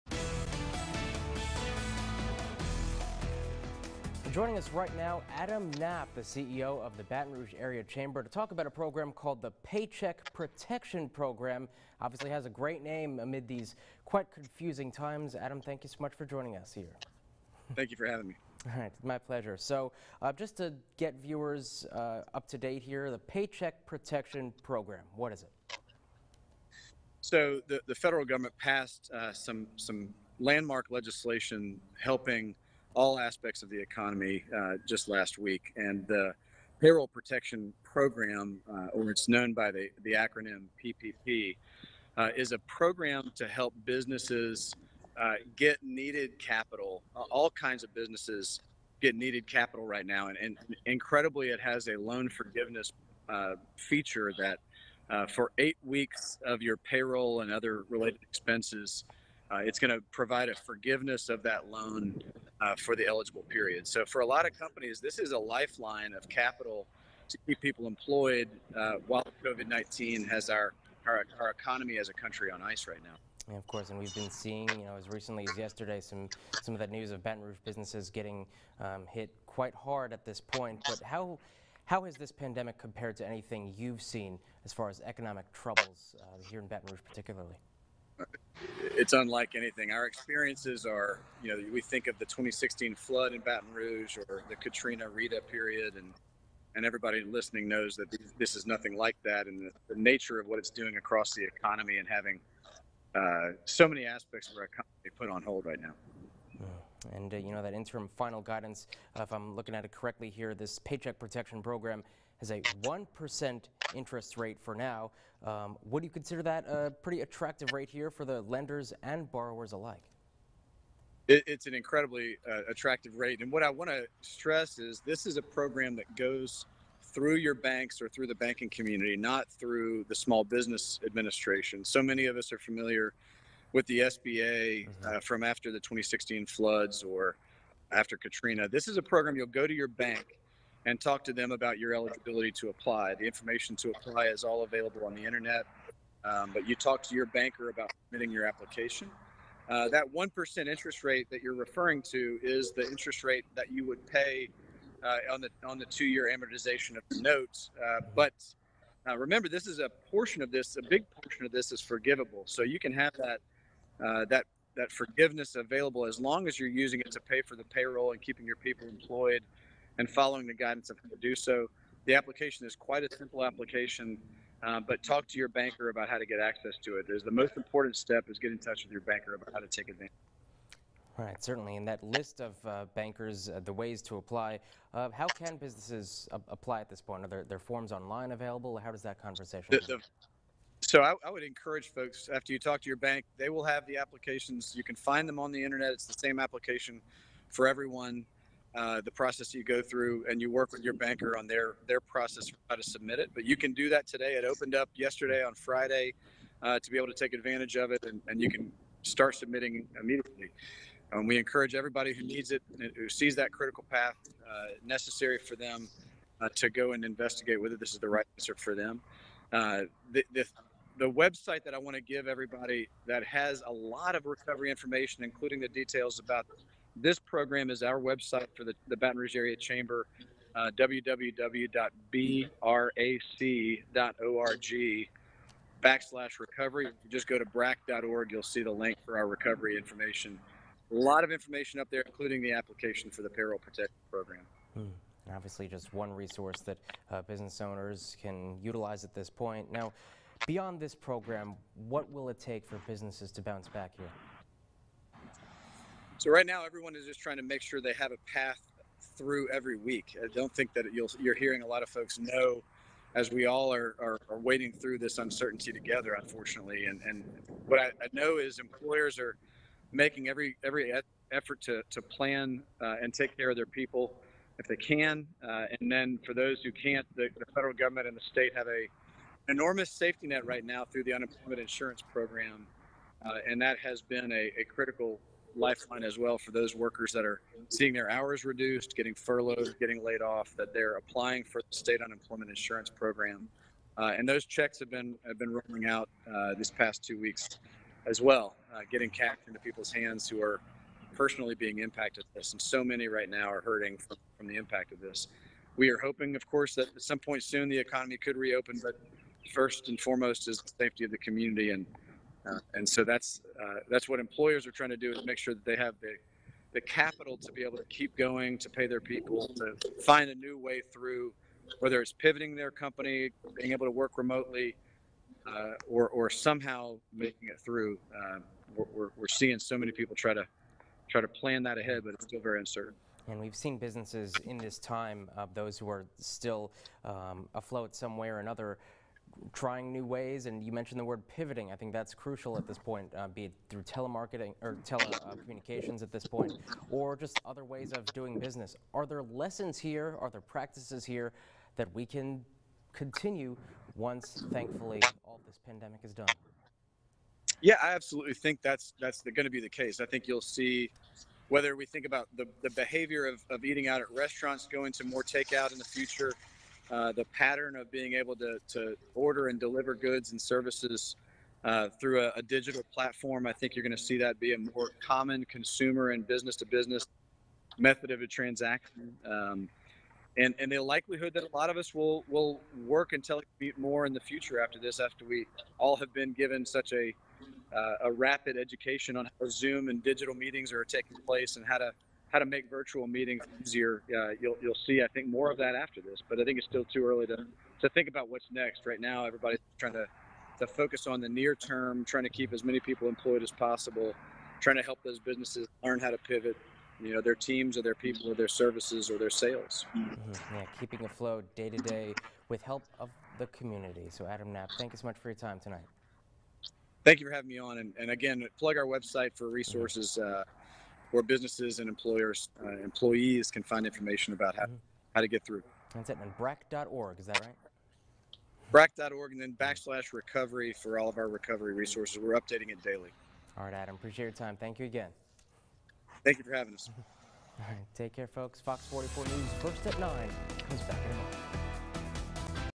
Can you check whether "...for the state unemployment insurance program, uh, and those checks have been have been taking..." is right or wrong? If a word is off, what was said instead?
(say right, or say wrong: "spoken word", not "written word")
wrong: "rolling", not "taking".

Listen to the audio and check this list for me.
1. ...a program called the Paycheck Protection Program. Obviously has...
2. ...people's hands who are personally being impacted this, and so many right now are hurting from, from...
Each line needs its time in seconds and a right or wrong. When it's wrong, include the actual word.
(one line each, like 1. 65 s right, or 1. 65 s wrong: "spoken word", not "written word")
1. 8 s right
2. 299 s right.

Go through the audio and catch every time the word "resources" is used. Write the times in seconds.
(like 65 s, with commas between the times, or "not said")
246 s, 419 s, 431 s.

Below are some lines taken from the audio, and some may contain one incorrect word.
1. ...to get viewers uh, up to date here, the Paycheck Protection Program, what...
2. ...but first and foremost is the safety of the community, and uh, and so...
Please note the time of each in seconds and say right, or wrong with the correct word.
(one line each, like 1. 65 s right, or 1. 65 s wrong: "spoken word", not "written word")
1. 20 s right
2. 308 s right.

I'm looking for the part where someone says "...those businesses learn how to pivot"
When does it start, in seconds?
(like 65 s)
405 s.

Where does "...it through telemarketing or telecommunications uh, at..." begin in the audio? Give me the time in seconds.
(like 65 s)
343 s.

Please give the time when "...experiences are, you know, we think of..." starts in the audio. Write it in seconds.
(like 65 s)
90 s.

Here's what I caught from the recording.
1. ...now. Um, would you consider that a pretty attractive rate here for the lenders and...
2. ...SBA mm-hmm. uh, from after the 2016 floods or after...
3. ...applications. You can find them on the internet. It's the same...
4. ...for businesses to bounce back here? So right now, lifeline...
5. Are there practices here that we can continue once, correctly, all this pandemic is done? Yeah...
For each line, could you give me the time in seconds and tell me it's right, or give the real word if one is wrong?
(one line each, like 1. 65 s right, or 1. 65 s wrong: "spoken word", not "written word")
1. 114 s right
2. 133 s right
3. 193 s right
4. 252 s wrong: "everyone", not "lifeline"
5. 350 s wrong: "thankfully", not "correctly".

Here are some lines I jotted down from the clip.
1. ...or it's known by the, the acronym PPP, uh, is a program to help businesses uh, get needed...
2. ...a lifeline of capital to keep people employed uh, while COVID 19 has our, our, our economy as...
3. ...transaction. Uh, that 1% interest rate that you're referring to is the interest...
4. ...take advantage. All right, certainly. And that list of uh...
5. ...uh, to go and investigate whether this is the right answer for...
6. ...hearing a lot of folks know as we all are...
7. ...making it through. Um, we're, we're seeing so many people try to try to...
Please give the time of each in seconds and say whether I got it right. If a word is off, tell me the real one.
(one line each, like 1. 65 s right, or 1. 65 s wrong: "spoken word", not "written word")
1. 38 s right
2. 65 s right
3. 148 s wrong: "application", not "transaction"
4. 179 s right
5. 216 s right
6. 261 s right
7. 327 s right.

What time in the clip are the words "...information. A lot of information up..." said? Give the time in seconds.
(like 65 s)
239 s.